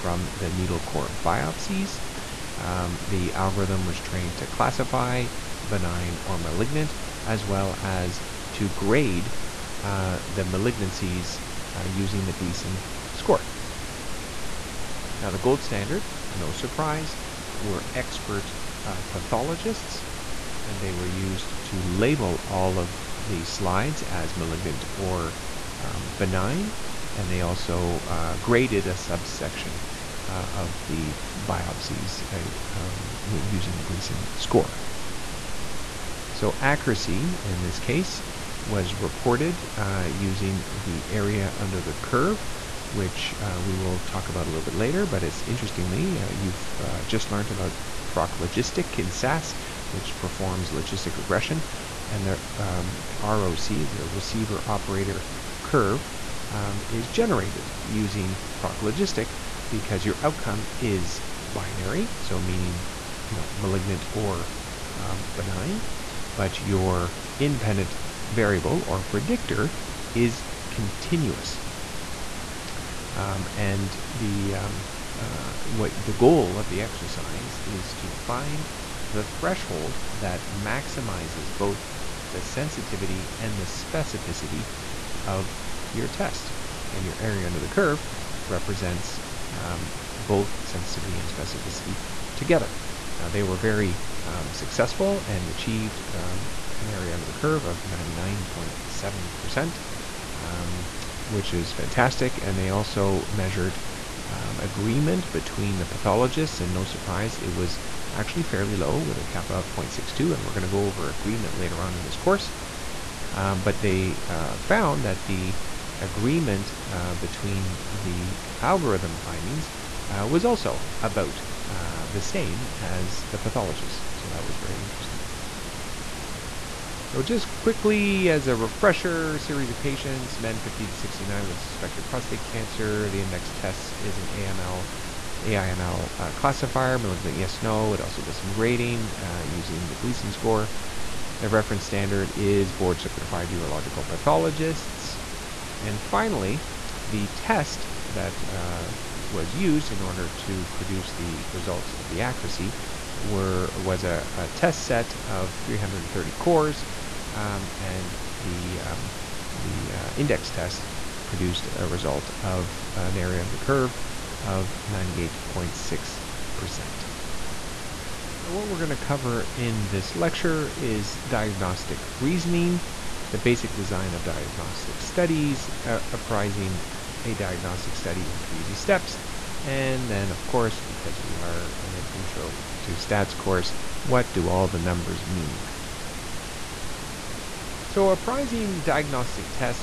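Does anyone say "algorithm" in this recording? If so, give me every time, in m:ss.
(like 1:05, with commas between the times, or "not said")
0:03, 1:58.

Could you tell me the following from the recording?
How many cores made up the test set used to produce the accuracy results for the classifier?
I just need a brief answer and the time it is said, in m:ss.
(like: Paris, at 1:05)
330, at 2:35.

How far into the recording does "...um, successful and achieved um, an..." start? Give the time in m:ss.
1:34.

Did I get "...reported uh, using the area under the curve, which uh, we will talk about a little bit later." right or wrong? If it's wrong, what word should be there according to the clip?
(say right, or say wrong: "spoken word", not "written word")
right.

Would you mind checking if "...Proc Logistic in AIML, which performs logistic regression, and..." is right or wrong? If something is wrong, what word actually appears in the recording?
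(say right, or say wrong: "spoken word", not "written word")
wrong: "SAS", not "AIML".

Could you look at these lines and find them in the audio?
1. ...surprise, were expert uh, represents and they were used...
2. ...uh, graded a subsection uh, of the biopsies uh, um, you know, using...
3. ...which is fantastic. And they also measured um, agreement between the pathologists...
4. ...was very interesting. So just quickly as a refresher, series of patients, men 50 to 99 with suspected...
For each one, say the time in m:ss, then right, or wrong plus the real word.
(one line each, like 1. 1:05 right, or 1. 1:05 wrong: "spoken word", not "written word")
1. 0:16 wrong: "pathologists", not "represents"
2. 0:28 right
3. 1:41 right
4. 2:04 wrong: "69", not "99".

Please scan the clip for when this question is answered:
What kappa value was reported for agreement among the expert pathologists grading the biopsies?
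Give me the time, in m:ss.
1:49.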